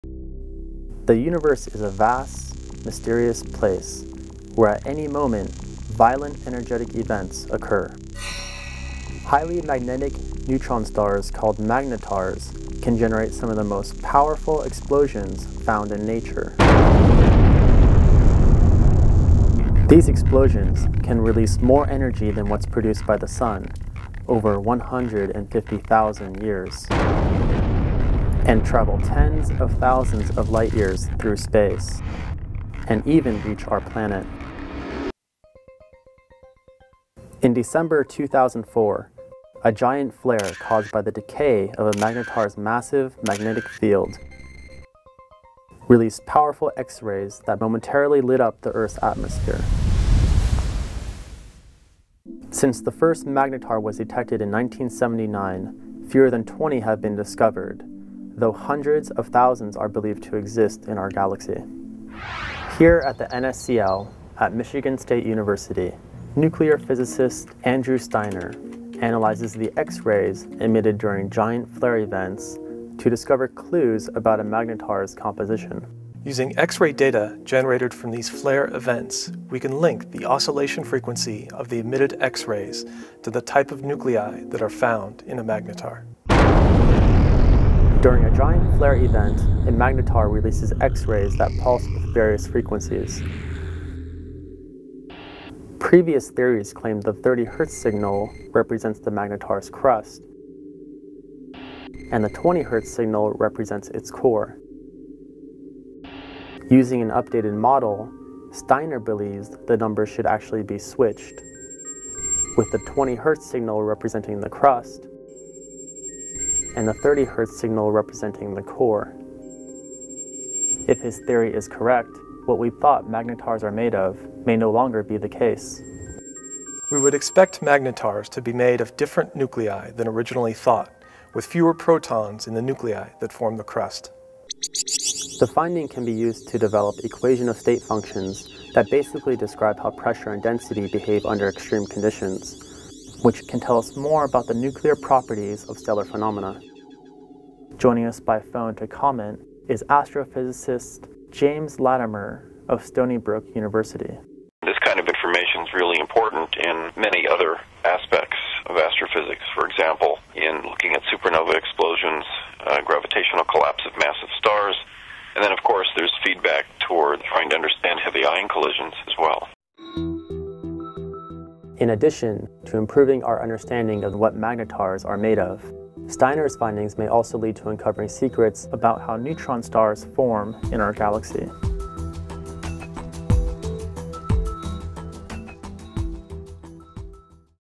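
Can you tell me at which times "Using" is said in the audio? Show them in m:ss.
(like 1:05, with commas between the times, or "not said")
1:16, 1:46.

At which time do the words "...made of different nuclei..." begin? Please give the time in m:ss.
2:08.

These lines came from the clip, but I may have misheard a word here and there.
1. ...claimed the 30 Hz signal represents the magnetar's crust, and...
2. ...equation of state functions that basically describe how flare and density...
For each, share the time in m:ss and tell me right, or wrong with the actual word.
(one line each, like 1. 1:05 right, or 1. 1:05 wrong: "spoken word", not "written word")
1. 1:36 right
2. 2:17 wrong: "pressure", not "flare".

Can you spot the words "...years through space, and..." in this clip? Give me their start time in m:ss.
0:30.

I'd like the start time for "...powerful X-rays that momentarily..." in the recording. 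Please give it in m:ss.
0:46.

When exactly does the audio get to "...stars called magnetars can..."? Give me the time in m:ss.
0:10.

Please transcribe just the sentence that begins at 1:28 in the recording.
During a giant flare event, a magnetar releases X-rays that pulse with various frequencies.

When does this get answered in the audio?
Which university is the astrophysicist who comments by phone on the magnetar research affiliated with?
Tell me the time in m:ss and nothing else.
2:32.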